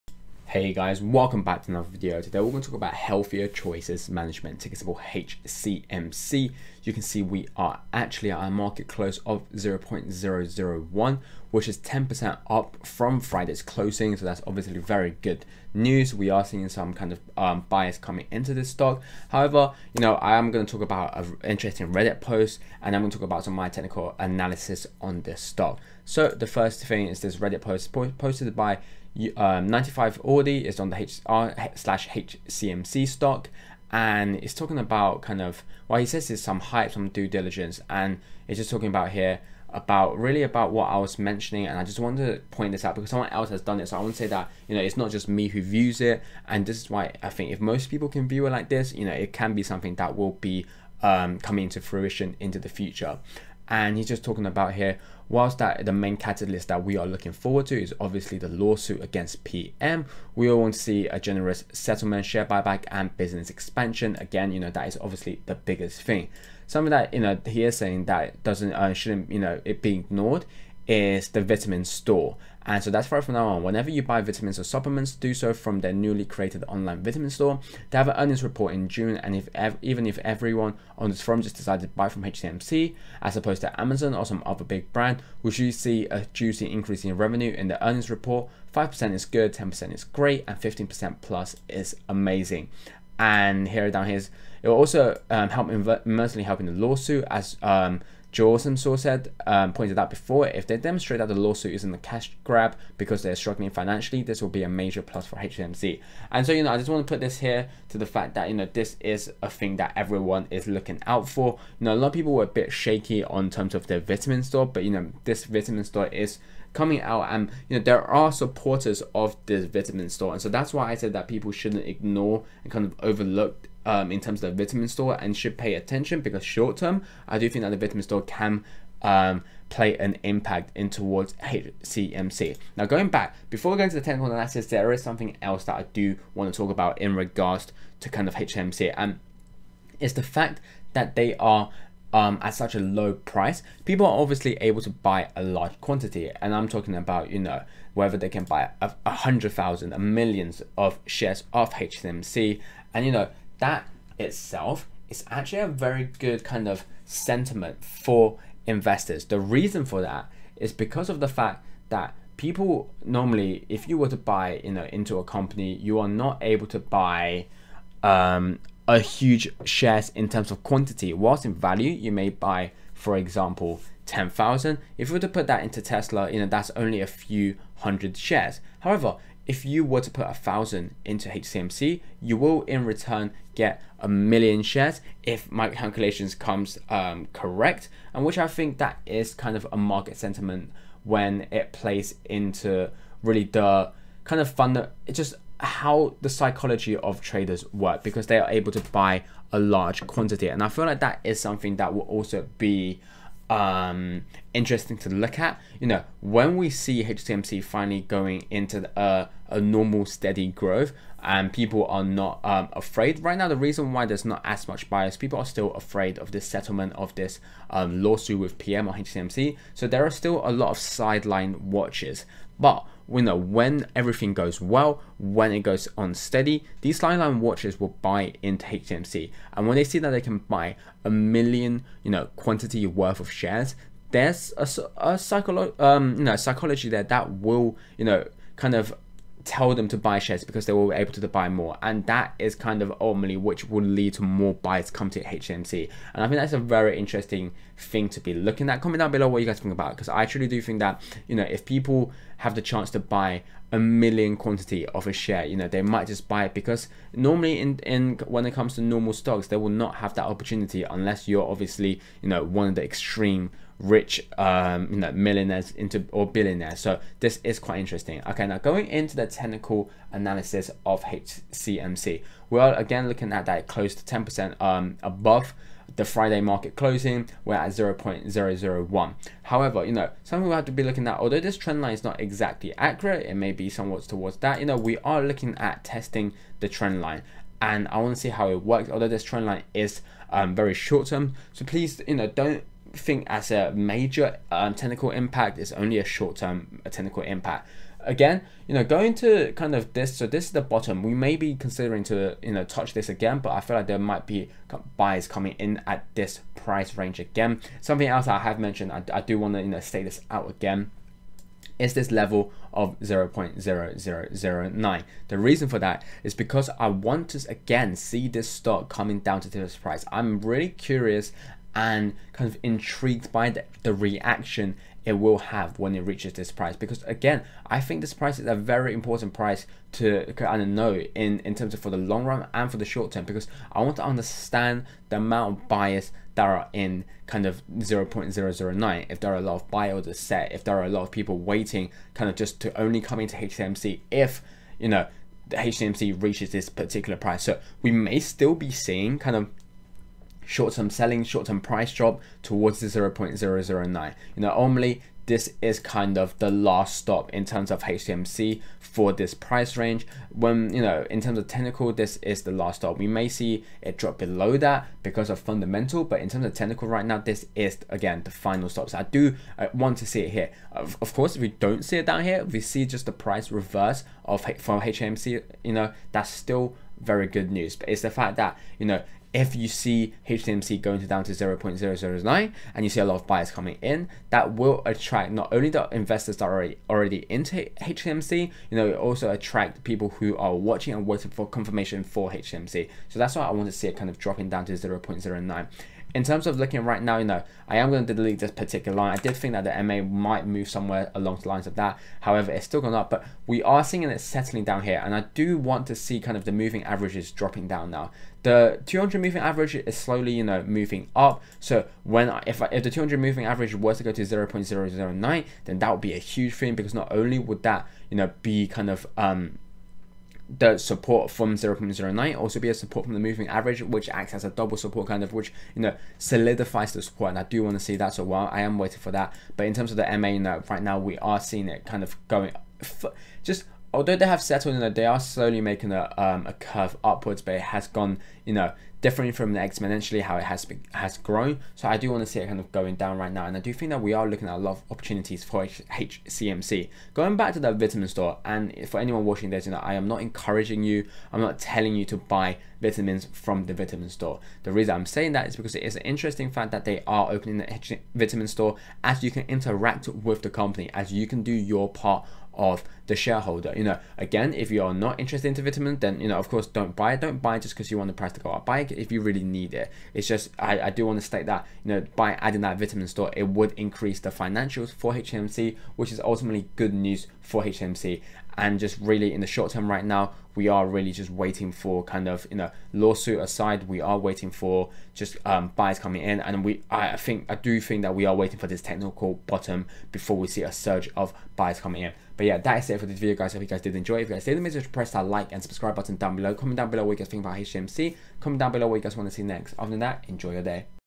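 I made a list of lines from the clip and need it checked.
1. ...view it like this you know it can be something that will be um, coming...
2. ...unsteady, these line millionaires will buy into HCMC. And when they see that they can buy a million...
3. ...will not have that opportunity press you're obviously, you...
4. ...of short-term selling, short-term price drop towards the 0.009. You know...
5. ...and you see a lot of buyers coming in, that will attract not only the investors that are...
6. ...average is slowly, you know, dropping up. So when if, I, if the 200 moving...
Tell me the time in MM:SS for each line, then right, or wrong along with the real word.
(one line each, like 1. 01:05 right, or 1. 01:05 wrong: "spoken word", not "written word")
1. 00:48 right
2. 03:45 wrong: "watches", not "millionaires"
3. 04:19 wrong: "unless", not "press"
4. 05:49 right
5. 06:22 right
6. 06:49 wrong: "moving", not "dropping".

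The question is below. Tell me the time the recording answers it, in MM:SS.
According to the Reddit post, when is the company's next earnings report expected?
01:18.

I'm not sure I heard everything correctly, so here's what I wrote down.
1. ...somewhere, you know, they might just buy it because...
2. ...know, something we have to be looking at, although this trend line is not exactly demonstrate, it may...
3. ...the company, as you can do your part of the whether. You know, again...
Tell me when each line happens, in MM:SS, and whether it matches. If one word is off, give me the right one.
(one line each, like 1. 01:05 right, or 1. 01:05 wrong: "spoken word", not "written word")
1. 04:15 wrong: "share", not "somewhere"
2. 04:39 wrong: "accurate", not "demonstrate"
3. 07:40 wrong: "shareholder", not "whether".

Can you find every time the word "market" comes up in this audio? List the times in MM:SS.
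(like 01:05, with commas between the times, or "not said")
00:08, 03:09, 04:36.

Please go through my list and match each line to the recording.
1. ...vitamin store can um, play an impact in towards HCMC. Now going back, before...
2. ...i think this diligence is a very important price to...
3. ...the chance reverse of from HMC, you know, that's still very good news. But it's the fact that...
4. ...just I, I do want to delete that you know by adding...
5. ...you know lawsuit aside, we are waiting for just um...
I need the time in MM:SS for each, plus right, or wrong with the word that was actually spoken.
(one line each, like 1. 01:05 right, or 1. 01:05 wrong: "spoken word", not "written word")
1. 02:07 right
2. 05:27 wrong: "price", not "diligence"
3. 06:13 wrong: "price", not "chance"
4. 07:50 wrong: "state", not "delete"
5. 08:02 right.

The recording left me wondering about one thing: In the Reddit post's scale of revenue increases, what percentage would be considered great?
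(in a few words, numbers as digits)
10%.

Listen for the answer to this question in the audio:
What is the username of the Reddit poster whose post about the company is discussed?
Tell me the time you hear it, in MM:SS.
00:29.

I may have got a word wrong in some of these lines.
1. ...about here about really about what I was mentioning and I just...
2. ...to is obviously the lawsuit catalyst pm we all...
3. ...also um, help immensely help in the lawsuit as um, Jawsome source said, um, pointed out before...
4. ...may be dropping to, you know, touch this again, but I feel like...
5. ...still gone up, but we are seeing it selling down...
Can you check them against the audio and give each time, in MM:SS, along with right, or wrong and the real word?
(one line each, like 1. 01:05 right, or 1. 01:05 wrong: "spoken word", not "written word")
1. 00:38 right
2. 00:57 wrong: "against", not "catalyst"
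3. 01:34 right
4. 05:01 wrong: "considering", not "dropping"
5. 06:42 wrong: "settling", not "selling".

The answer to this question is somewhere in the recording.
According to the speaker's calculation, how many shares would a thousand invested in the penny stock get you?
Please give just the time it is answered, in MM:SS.
03:03.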